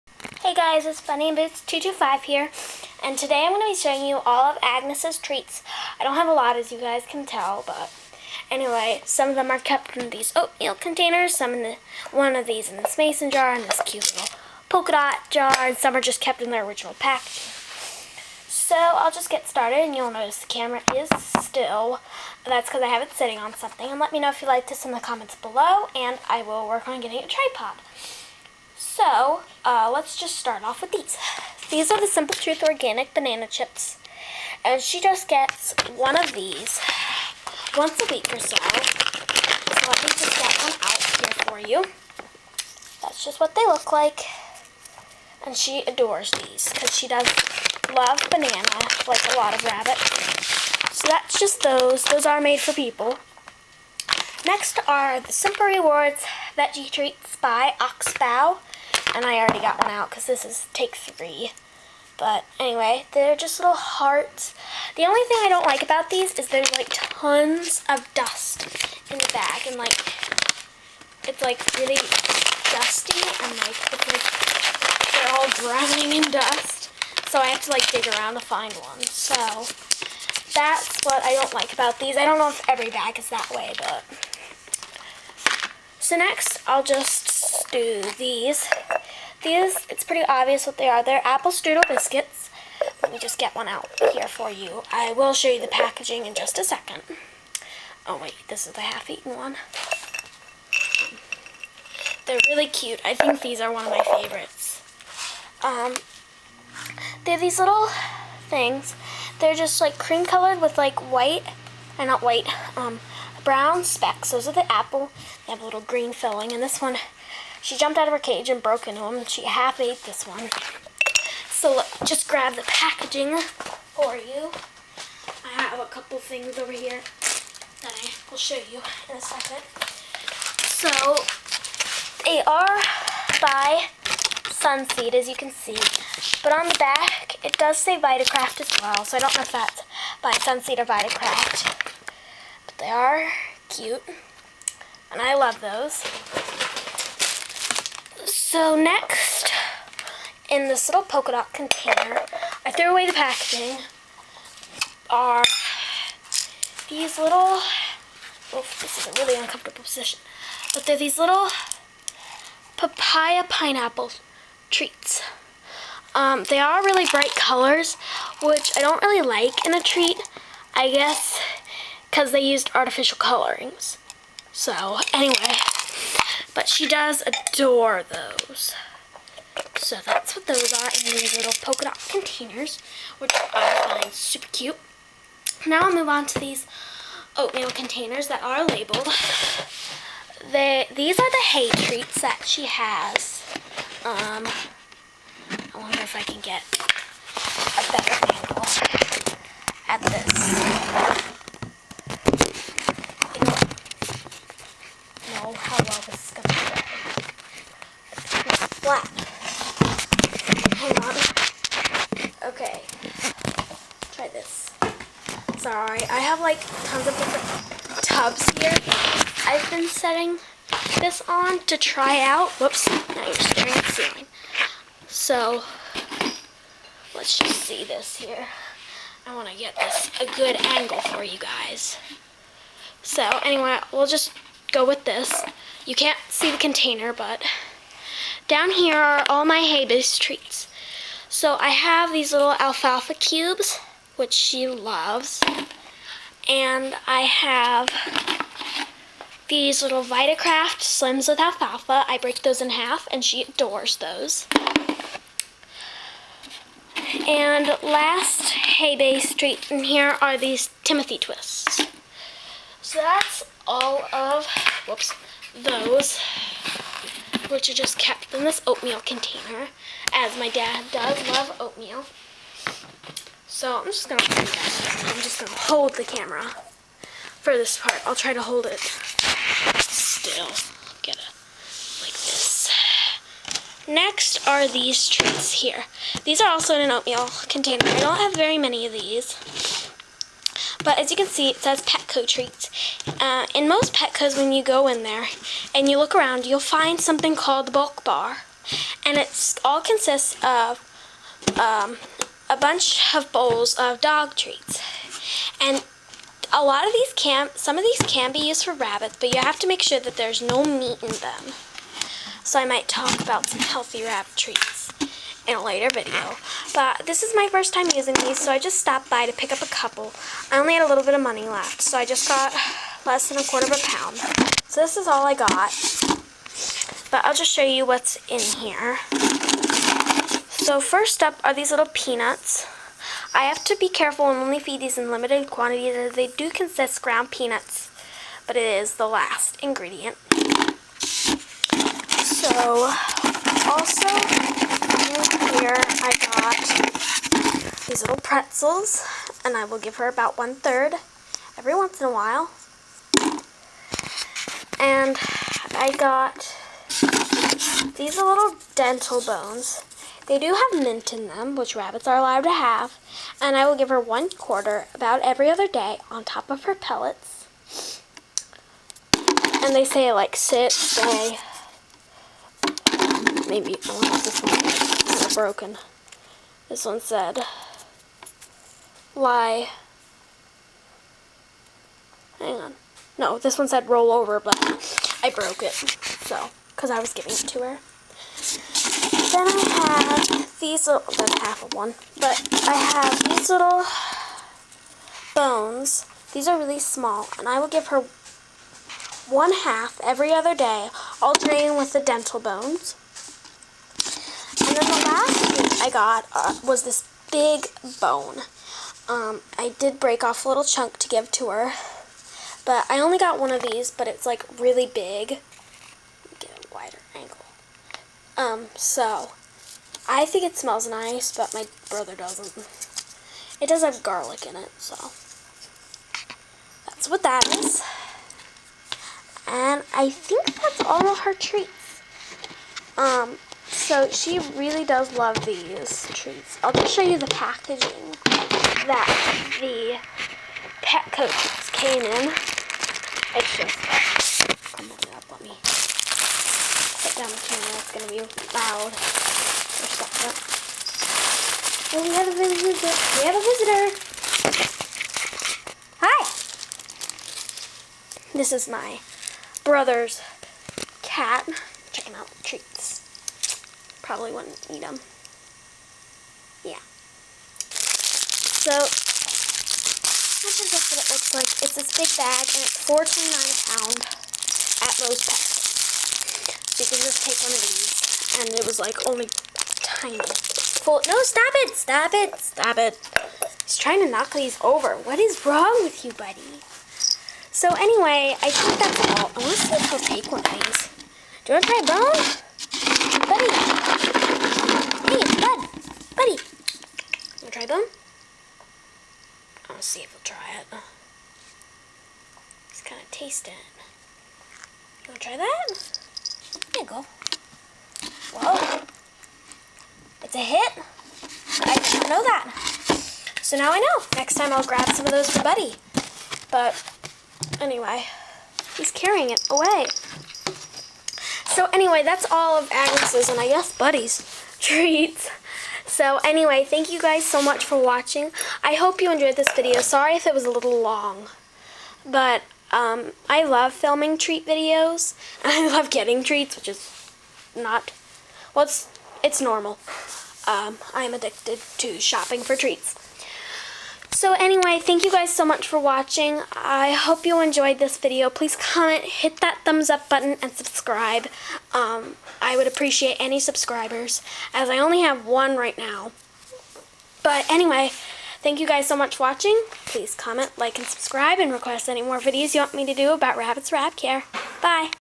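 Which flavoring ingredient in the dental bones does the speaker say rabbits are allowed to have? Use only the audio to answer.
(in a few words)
Mint.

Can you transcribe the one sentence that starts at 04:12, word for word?
I break those in half, and she adores those.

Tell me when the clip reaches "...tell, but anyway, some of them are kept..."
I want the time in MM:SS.
00:07.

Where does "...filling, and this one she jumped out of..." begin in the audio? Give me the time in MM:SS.
01:56.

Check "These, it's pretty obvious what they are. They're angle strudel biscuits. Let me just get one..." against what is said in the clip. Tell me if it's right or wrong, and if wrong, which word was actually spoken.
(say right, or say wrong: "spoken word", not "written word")
wrong: "apple", not "angle".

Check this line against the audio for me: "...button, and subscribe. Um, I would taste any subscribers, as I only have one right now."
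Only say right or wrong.
wrong.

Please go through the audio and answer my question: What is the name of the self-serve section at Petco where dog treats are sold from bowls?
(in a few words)
Bulk bar.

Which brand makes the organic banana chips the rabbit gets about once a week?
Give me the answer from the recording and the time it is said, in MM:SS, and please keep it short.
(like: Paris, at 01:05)
Simple Truth, at 00:32.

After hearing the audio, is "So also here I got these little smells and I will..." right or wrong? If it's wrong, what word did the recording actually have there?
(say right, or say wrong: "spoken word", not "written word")
wrong: "pretzels", not "smells".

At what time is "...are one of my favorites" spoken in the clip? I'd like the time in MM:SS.
01:43.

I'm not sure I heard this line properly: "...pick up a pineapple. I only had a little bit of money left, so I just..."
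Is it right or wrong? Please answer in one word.
wrong.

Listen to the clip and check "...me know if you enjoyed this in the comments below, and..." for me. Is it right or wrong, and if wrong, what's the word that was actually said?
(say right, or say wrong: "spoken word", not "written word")
wrong: "liked", not "enjoyed".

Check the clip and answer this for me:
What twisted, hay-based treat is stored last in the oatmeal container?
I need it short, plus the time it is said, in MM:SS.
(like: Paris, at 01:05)
Timothy twists, at 04:20.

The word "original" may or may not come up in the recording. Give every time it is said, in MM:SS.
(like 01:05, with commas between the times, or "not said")
00:16.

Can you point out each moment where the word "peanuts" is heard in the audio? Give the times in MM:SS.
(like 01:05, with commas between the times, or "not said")
05:31, 05:37.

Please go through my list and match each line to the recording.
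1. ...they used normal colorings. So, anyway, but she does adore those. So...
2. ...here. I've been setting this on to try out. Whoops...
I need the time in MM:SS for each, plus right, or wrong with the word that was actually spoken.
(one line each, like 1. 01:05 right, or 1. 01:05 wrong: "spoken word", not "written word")
1. 02:52 wrong: "artificial", not "normal"
2. 03:38 right.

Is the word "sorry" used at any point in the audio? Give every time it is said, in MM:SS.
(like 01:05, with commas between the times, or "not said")
03:35, 08:49.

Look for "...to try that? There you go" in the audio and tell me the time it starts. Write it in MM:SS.
08:25.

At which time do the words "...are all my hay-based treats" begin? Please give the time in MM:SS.
03:58.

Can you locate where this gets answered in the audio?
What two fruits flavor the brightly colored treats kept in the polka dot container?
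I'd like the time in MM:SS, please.
02:42.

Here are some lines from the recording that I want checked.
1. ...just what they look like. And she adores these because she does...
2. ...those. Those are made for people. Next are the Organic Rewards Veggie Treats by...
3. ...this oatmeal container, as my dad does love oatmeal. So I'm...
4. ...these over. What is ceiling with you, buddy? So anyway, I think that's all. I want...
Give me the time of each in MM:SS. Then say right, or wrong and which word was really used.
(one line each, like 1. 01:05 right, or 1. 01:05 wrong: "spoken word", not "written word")
1. 00:43 right
2. 00:51 wrong: "Simple", not "Organic"
3. 04:28 right
4. 08:04 wrong: "wrong", not "ceiling".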